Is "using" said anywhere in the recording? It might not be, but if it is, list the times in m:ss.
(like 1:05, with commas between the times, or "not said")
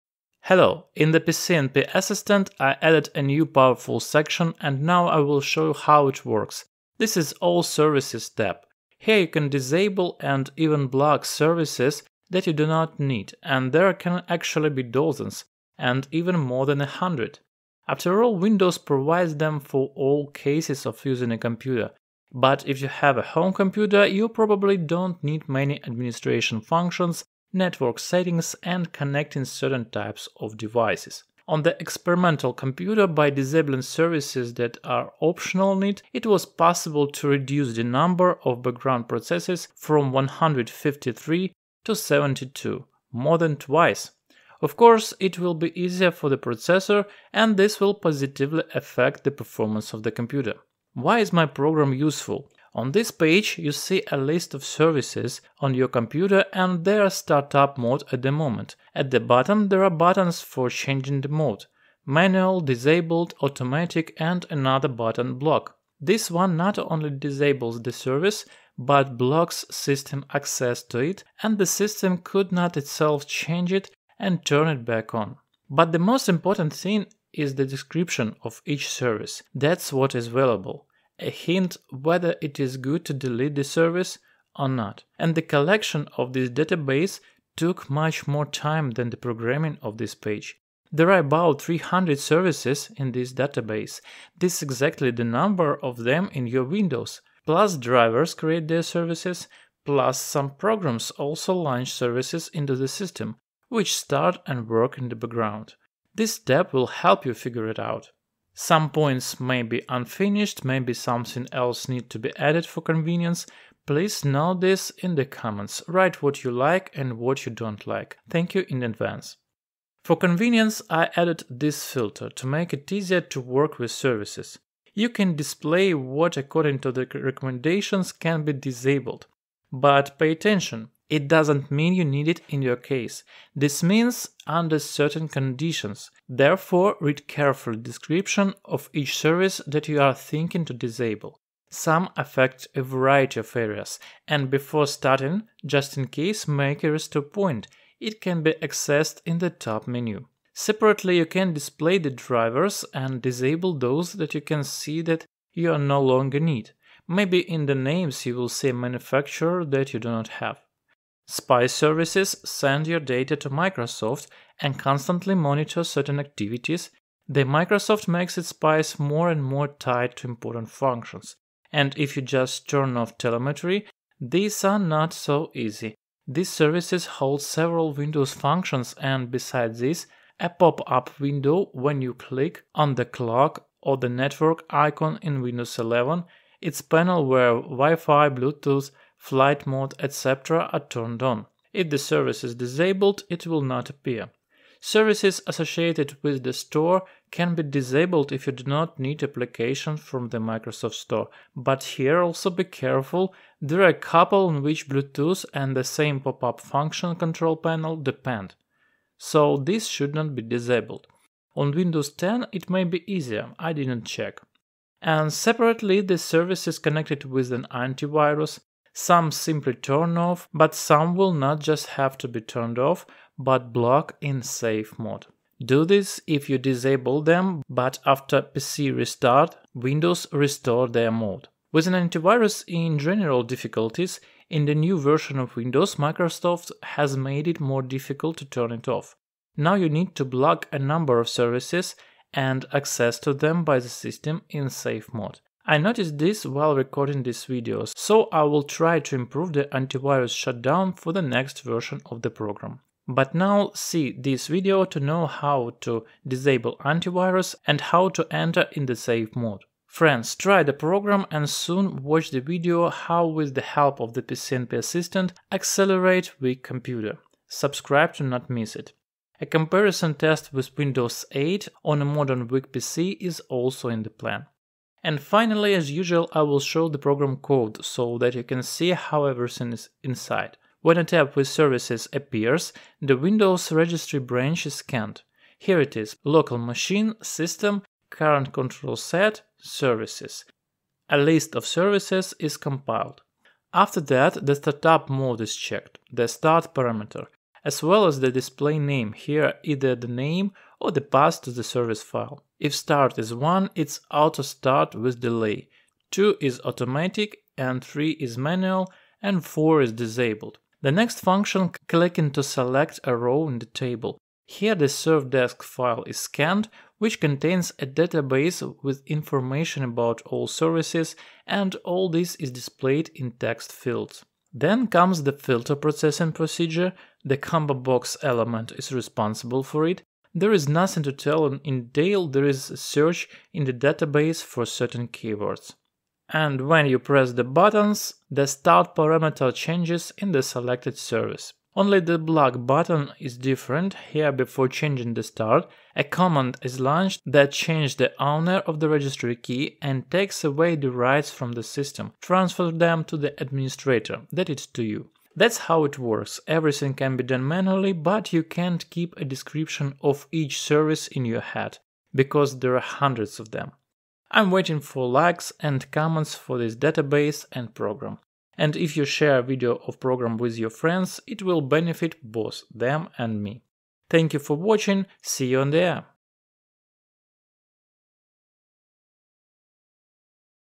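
0:21.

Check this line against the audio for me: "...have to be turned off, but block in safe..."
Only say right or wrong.
right.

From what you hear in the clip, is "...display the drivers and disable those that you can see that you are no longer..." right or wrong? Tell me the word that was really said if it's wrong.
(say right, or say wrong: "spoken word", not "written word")
right.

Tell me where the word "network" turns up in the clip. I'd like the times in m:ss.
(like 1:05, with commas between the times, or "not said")
0:27, 3:04.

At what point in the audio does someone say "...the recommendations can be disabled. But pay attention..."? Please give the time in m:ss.
2:06.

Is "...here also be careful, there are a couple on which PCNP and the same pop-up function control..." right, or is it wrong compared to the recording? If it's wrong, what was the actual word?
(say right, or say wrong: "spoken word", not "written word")
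wrong: "Bluetooth", not "PCNP".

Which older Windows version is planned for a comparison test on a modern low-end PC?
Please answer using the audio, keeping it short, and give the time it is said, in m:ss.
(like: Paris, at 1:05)
Windows 8, at 4:30.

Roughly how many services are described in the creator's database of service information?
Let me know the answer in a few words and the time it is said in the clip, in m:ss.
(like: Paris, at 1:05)
300, at 1:31.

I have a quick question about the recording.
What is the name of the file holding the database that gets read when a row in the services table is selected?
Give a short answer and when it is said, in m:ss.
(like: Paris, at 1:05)
servdesk, at 5:14.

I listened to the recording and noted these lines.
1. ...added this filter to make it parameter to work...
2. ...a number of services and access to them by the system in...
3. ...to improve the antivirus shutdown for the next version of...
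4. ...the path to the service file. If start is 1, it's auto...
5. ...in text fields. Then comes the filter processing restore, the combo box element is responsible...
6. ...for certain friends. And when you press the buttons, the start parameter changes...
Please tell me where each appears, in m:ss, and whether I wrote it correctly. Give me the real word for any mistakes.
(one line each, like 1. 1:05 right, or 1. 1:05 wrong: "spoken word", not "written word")
1. 2:01 wrong: "easier", not "parameter"
2. 4:00 right
3. 4:09 right
4. 5:00 right
5. 5:23 wrong: "procedure", not "restore"
6. 5:34 wrong: "keywords", not "friends".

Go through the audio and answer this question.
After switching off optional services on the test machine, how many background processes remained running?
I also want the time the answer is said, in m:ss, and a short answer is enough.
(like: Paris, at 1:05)
72, at 0:41.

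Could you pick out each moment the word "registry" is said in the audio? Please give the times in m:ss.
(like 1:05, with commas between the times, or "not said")
4:43, 5:48.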